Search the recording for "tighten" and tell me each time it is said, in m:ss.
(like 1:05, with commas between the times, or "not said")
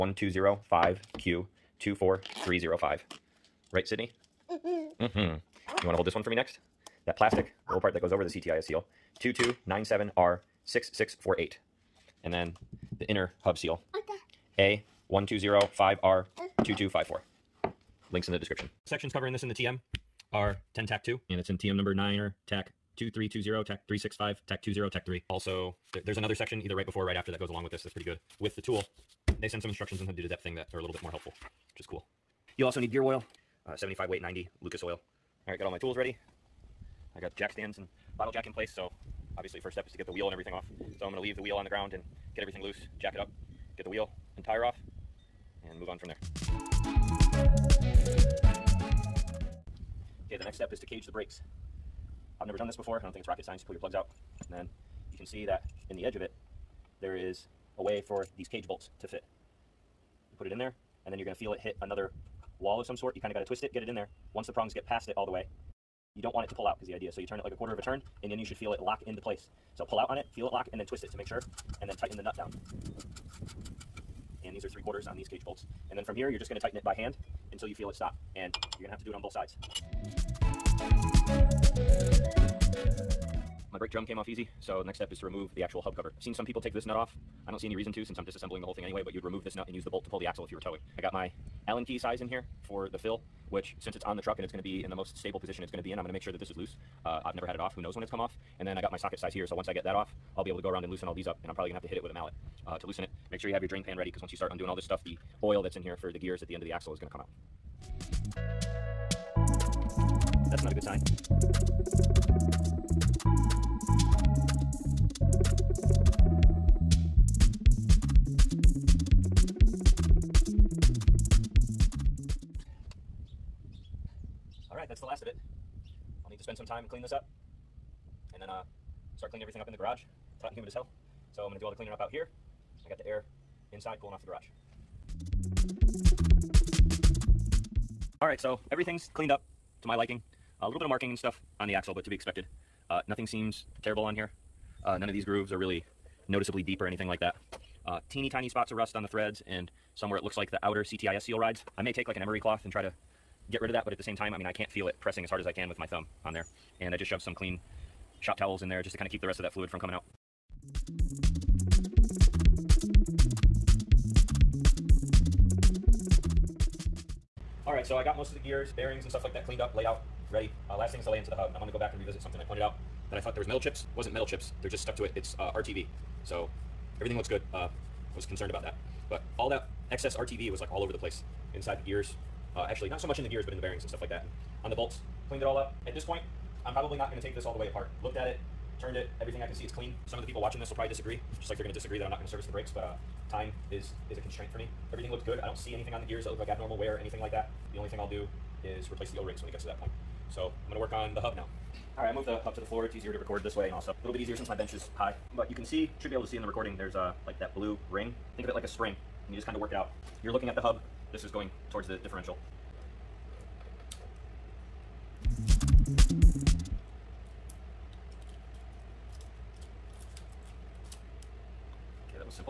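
1:11, 1:16.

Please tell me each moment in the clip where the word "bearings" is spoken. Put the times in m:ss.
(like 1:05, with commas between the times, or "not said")
2:48, 3:03.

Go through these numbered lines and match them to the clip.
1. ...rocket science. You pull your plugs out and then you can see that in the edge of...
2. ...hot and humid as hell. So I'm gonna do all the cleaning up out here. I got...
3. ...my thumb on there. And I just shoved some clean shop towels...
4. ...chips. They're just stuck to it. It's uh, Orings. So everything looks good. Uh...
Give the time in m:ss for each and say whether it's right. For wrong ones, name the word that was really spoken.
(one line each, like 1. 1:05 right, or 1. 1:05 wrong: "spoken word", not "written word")
1. 0:53 right
2. 2:10 right
3. 2:35 right
4. 2:54 wrong: "RTV", not "Orings".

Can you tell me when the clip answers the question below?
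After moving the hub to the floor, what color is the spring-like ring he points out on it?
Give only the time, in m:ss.
3:27.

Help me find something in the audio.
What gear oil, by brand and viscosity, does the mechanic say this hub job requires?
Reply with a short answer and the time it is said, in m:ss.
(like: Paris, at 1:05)
75W-90 Lucas oil, at 0:33.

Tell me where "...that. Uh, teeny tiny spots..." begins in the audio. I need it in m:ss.
2:27.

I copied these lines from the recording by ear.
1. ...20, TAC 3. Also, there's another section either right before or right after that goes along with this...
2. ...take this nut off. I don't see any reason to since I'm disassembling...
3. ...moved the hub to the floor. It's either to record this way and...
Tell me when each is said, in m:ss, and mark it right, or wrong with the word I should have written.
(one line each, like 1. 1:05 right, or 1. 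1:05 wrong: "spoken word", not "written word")
1. 0:24 right
2. 1:26 right
3. 3:22 wrong: "easier", not "either".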